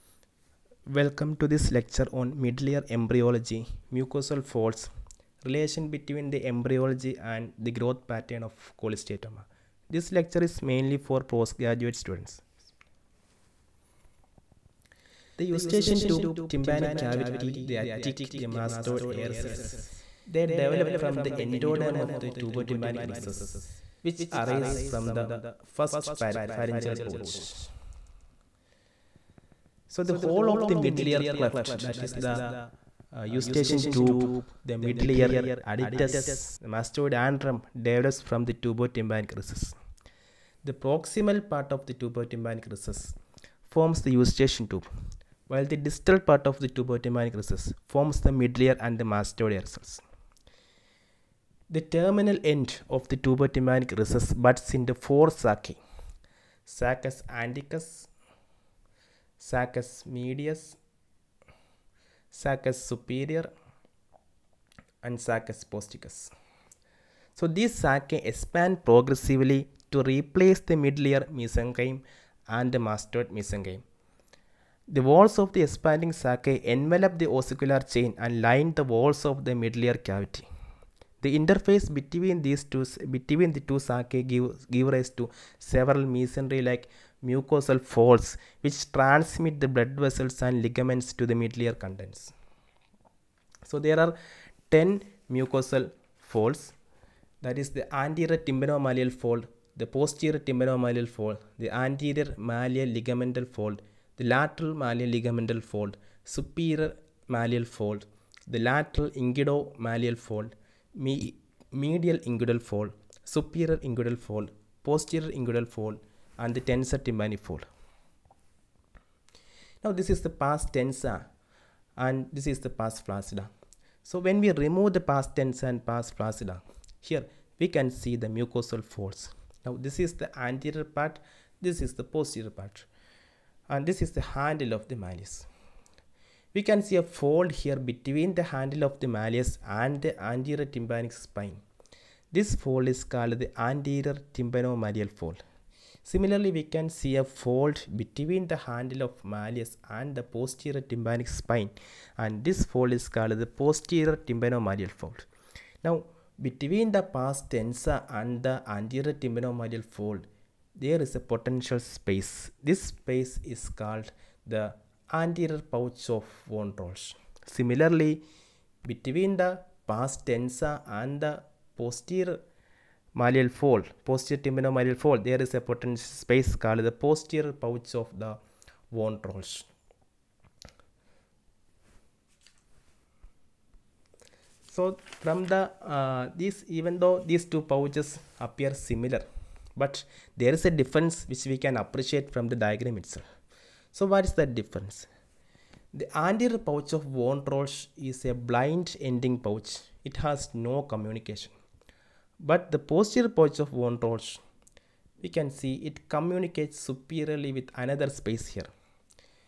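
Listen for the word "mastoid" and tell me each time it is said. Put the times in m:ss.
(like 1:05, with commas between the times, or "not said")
0:18, 0:36, 0:49, 1:12.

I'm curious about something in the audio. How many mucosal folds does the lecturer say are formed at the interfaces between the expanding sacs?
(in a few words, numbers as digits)
10.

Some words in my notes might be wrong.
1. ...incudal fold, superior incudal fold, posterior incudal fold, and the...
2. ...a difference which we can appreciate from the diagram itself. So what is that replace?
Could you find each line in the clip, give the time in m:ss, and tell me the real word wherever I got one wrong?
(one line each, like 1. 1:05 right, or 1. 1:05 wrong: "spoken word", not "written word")
1. 1:52 right
2. 3:10 wrong: "difference", not "replace".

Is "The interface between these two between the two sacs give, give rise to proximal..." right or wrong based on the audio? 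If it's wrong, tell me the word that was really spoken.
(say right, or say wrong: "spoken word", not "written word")
wrong: "several", not "proximal".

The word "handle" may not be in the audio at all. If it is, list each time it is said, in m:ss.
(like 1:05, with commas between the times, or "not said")
2:14, 2:18, 2:28.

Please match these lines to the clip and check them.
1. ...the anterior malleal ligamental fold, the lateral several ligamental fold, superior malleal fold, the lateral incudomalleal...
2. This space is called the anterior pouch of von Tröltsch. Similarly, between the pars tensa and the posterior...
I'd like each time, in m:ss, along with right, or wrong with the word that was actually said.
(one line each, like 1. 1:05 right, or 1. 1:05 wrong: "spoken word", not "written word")
1. 1:41 wrong: "malleal", not "several"
2. 2:42 right.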